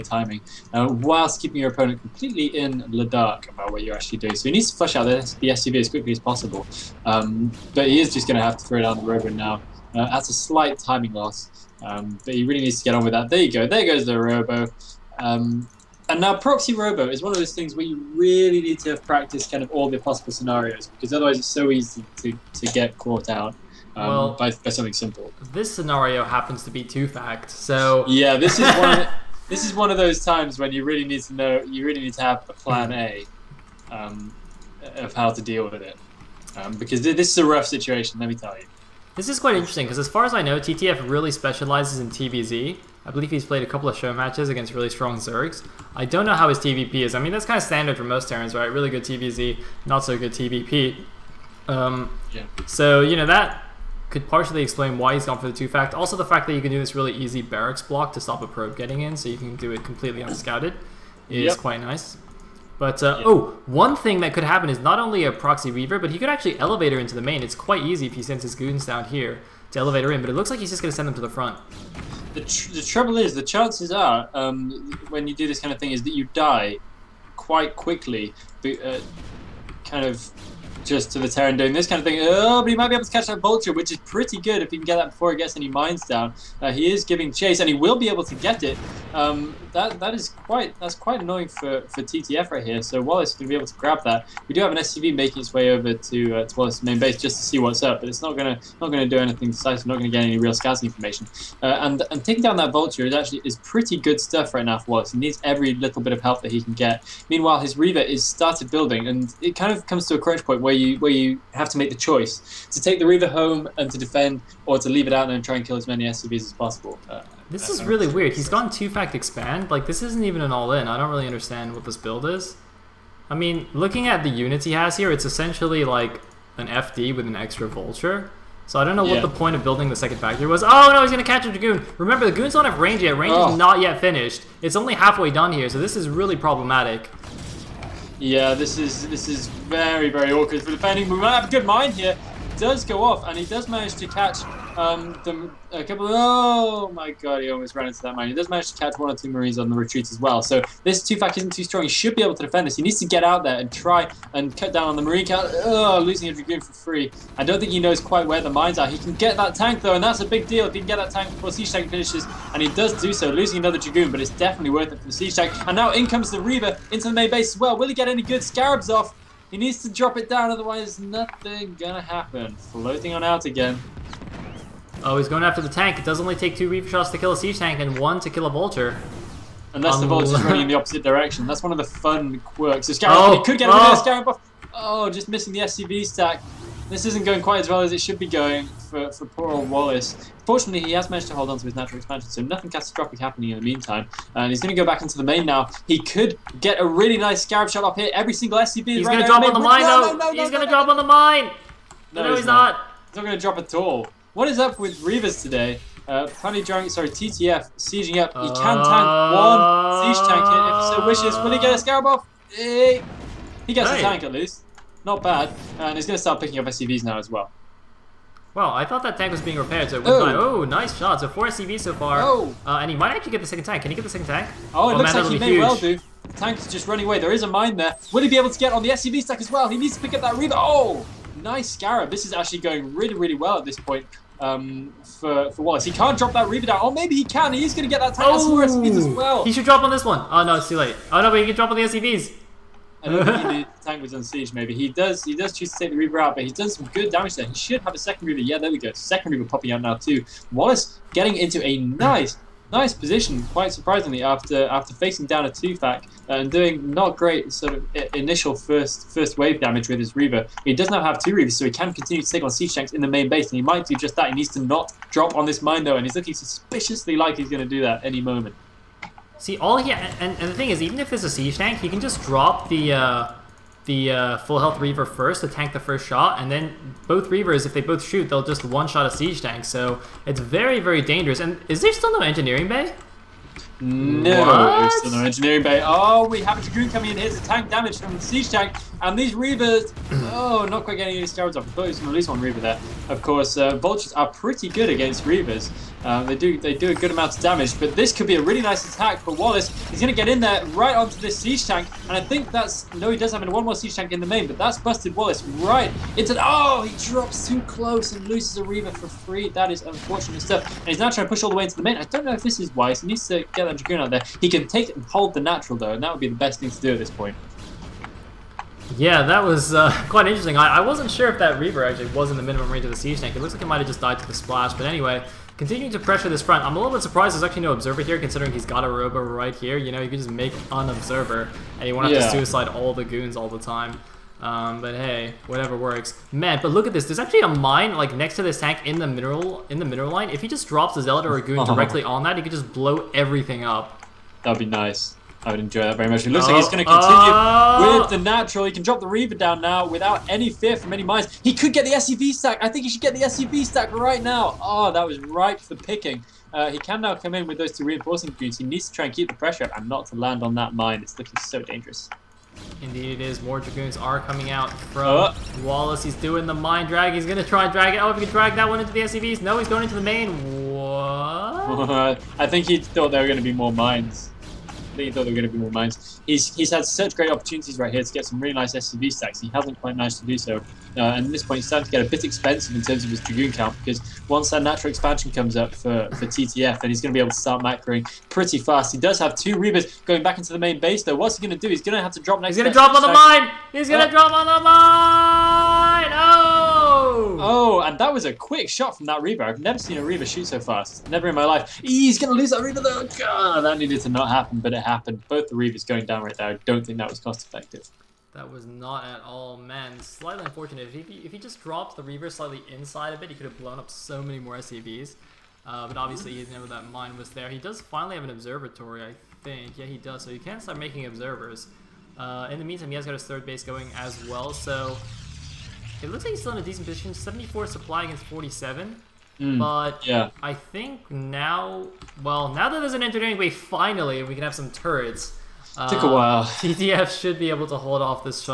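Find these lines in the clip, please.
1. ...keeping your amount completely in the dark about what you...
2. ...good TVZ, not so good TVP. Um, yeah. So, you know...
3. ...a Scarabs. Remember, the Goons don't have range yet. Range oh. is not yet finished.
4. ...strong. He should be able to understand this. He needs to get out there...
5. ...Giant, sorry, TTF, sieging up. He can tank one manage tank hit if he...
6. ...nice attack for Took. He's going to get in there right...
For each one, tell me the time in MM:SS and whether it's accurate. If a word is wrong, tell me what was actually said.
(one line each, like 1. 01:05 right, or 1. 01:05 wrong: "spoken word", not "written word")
1. 00:01 wrong: "opponent", not "amount"
2. 00:48 right
3. 02:11 wrong: "Dragoon", not "Scarabs"
4. 02:31 wrong: "defend", not "understand"
5. 03:26 wrong: "siege", not "manage"
6. 04:58 wrong: "Wallace", not "Took".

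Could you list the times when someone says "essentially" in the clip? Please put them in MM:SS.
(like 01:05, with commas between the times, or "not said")
02:05.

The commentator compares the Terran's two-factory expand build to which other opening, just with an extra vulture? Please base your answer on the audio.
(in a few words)
FD.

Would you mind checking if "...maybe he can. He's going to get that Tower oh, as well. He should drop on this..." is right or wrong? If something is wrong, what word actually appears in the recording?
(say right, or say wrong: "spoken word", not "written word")
right.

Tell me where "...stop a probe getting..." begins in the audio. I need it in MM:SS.
00:58.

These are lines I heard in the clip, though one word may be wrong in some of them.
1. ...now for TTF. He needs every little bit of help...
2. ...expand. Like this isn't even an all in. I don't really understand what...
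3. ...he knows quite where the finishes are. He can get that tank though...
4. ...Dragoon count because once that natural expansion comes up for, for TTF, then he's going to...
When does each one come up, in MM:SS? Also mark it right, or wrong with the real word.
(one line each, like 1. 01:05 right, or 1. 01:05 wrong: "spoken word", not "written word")
1. 01:44 wrong: "Wallace", not "TTF"
2. 01:59 right
3. 02:37 wrong: "mines", not "finishes"
4. 06:23 right.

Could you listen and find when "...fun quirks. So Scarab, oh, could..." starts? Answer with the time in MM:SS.
03:01.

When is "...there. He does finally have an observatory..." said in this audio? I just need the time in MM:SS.
06:57.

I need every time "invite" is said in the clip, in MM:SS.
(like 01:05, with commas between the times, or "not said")
not said.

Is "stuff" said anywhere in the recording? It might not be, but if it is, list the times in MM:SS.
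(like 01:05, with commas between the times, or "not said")
01:44, 05:10.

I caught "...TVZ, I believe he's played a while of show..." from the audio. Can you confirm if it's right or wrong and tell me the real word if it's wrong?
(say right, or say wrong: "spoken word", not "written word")
wrong: "couple", not "while".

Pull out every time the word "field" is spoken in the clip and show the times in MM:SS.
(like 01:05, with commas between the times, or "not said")
not said.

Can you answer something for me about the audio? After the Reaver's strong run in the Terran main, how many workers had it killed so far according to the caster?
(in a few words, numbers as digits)
4.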